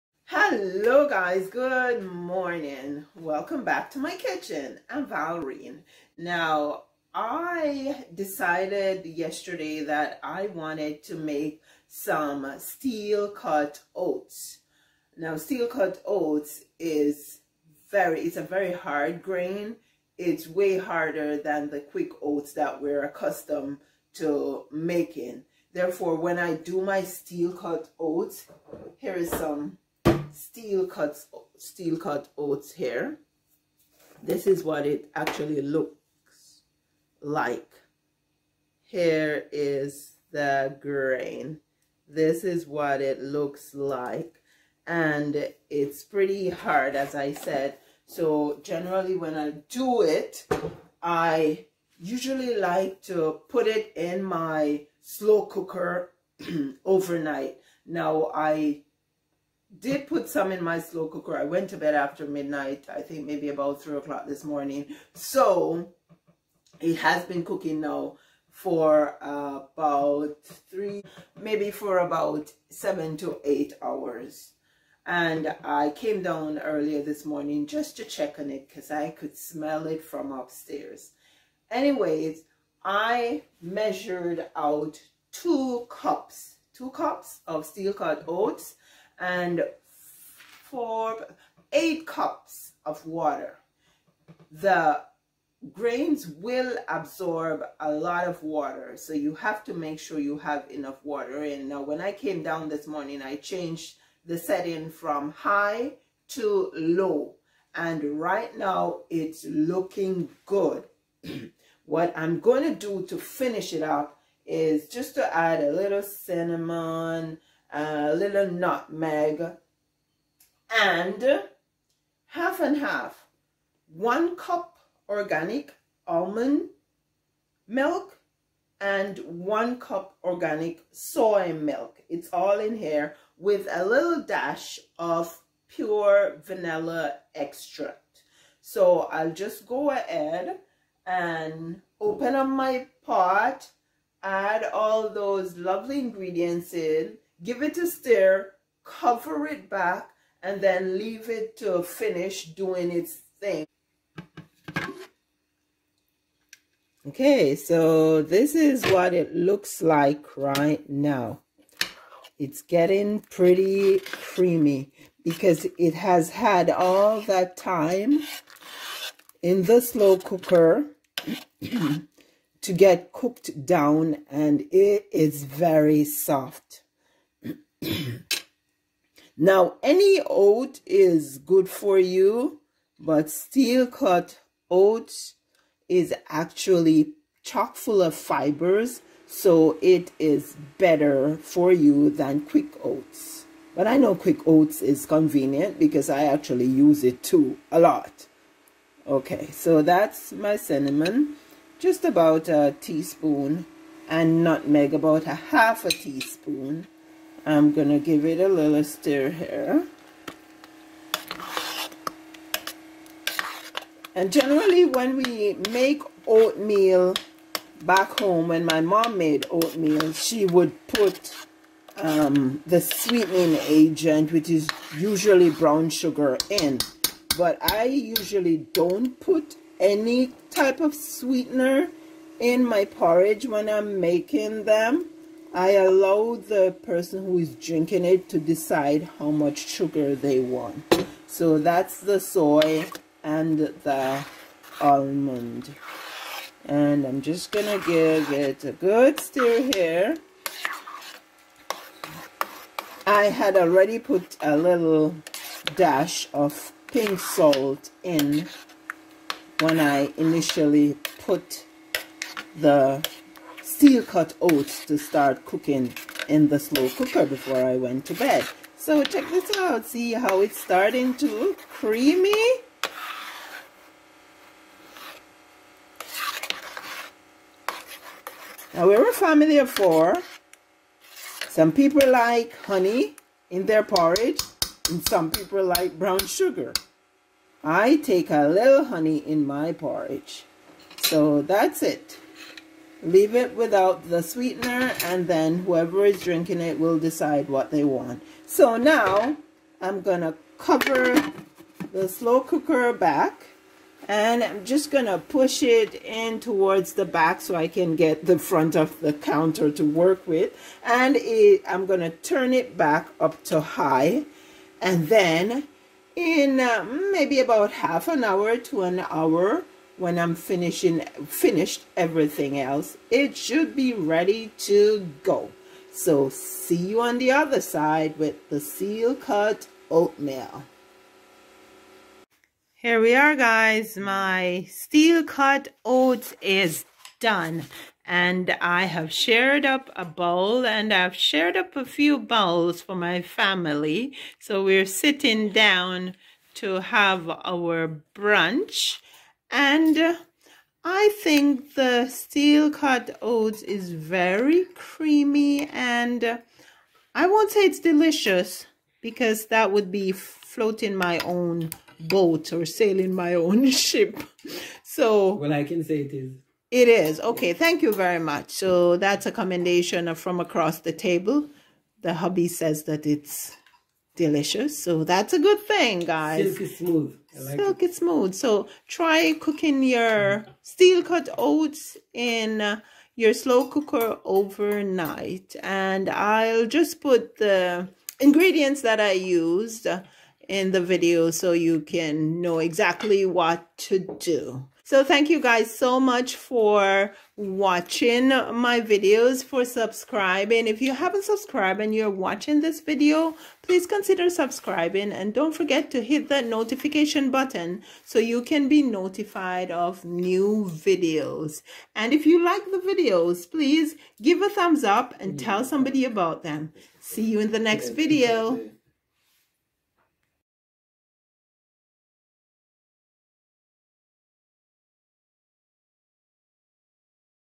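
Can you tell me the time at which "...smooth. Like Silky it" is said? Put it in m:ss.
6:16.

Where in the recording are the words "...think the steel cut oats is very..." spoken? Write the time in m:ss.
5:51.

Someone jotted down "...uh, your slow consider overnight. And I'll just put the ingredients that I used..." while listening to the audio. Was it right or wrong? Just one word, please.
wrong.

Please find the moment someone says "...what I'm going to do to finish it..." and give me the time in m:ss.
1:51.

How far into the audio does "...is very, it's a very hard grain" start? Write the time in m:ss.
0:16.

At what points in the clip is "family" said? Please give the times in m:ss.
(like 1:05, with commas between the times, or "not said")
4:39, 5:43.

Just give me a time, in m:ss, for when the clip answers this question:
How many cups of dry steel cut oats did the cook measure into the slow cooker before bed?
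1:26.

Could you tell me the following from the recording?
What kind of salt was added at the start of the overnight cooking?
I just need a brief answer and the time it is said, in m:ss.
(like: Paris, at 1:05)
pink salt, at 4:16.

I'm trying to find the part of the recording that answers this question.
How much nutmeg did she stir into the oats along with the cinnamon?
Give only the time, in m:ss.
3:24.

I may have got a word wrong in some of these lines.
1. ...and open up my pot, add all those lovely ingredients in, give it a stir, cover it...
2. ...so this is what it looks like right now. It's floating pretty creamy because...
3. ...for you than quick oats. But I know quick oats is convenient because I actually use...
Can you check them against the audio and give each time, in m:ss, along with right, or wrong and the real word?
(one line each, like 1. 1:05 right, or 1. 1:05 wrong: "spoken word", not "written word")
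1. 2:21 right
2. 2:37 wrong: "getting", not "floating"
3. 3:11 right.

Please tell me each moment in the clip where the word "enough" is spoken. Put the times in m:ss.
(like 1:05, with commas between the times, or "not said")
1:40.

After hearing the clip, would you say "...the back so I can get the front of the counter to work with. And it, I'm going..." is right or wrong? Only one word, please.
right.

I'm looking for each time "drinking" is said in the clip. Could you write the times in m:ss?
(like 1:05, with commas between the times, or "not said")
3:57, 4:56.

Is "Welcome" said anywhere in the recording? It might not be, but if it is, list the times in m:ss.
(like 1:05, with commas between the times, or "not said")
0:03.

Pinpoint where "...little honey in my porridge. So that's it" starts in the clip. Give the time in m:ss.
4:48.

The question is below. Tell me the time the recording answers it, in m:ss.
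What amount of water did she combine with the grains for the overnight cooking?
1:31.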